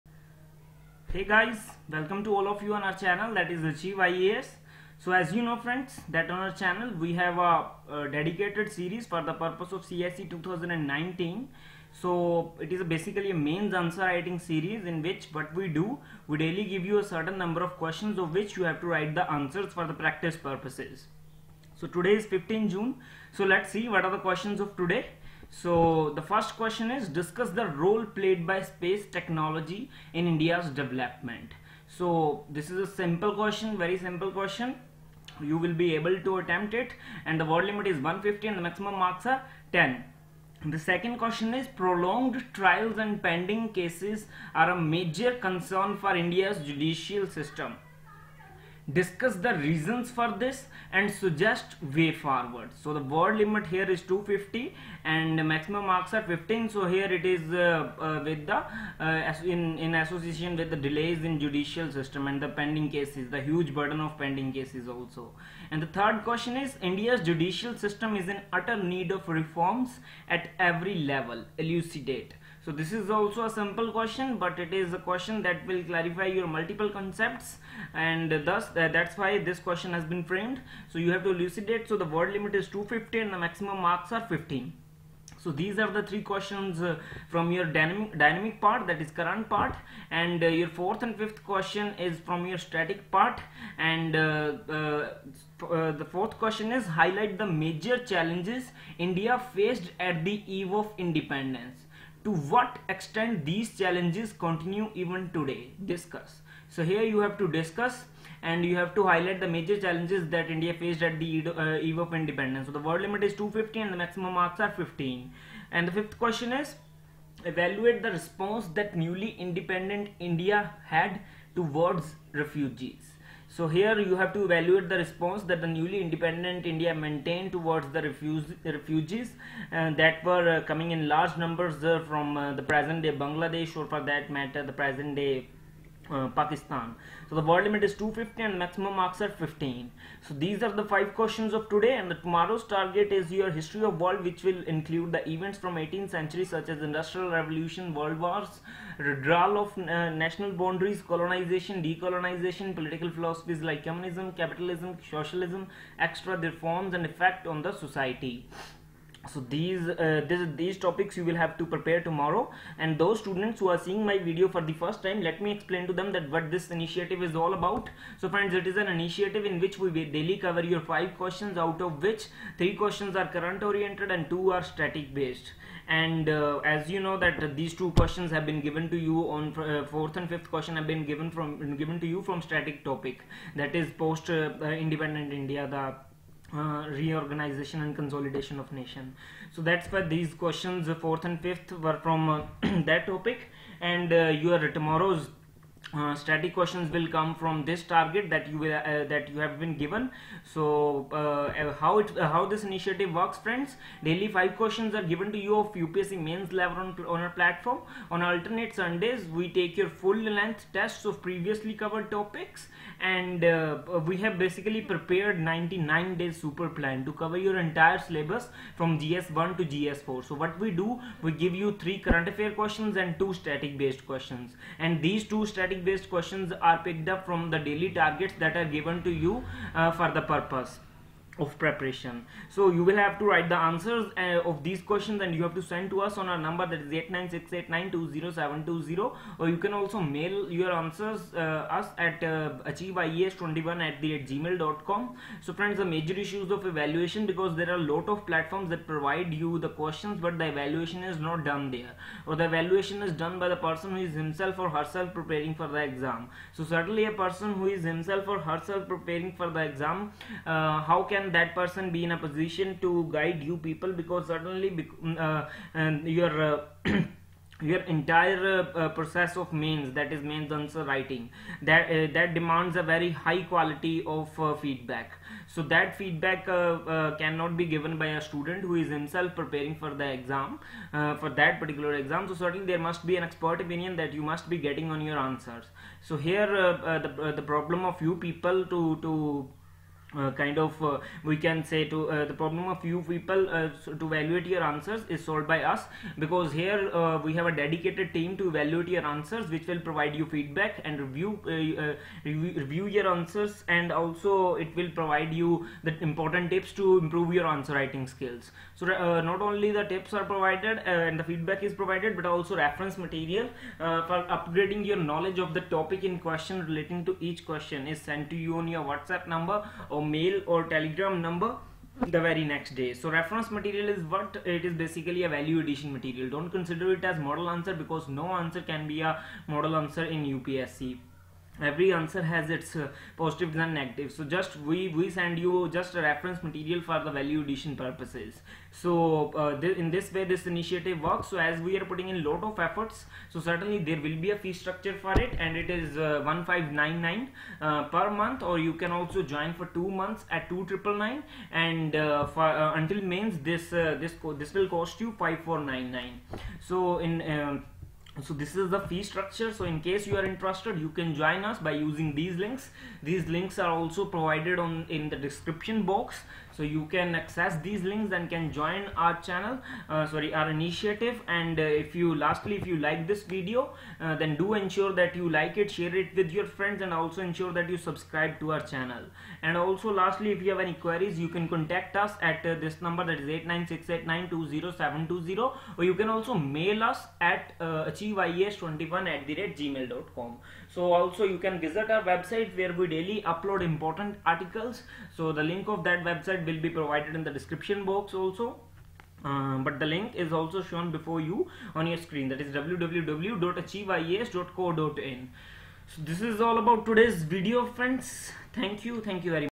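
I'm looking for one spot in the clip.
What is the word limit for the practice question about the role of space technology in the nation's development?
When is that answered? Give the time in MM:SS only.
00:37.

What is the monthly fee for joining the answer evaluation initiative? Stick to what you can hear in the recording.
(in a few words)
1599.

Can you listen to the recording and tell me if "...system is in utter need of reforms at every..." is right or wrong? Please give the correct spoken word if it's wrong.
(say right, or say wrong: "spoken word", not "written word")
right.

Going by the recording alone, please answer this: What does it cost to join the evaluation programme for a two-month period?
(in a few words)
2999.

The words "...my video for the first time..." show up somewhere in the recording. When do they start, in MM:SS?
02:44.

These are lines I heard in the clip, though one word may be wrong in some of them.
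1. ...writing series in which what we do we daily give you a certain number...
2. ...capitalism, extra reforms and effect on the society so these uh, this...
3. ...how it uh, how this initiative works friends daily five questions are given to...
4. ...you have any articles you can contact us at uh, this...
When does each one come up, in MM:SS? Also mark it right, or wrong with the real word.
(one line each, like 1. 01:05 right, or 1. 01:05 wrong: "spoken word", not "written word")
1. 00:13 right
2. 02:35 wrong: "socialism", not "capitalism"
3. 03:21 right
4. 06:20 wrong: "queries", not "articles".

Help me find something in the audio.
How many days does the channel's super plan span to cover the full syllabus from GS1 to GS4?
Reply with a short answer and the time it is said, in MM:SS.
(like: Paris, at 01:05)
99, at 03:35.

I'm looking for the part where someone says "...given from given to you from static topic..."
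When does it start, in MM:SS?
03:01.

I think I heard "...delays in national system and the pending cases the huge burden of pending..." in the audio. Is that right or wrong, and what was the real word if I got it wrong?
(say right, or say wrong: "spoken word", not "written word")
wrong: "judicial", not "national".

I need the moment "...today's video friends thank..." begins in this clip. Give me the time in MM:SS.
06:46.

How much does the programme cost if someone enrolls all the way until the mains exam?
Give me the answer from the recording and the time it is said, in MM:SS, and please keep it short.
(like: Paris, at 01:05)
5499, at 05:55.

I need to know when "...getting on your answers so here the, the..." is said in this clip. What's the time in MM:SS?
04:44.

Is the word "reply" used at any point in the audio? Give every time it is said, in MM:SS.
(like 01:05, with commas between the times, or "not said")
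not said.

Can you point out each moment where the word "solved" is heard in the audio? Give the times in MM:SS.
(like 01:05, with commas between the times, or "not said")
04:55.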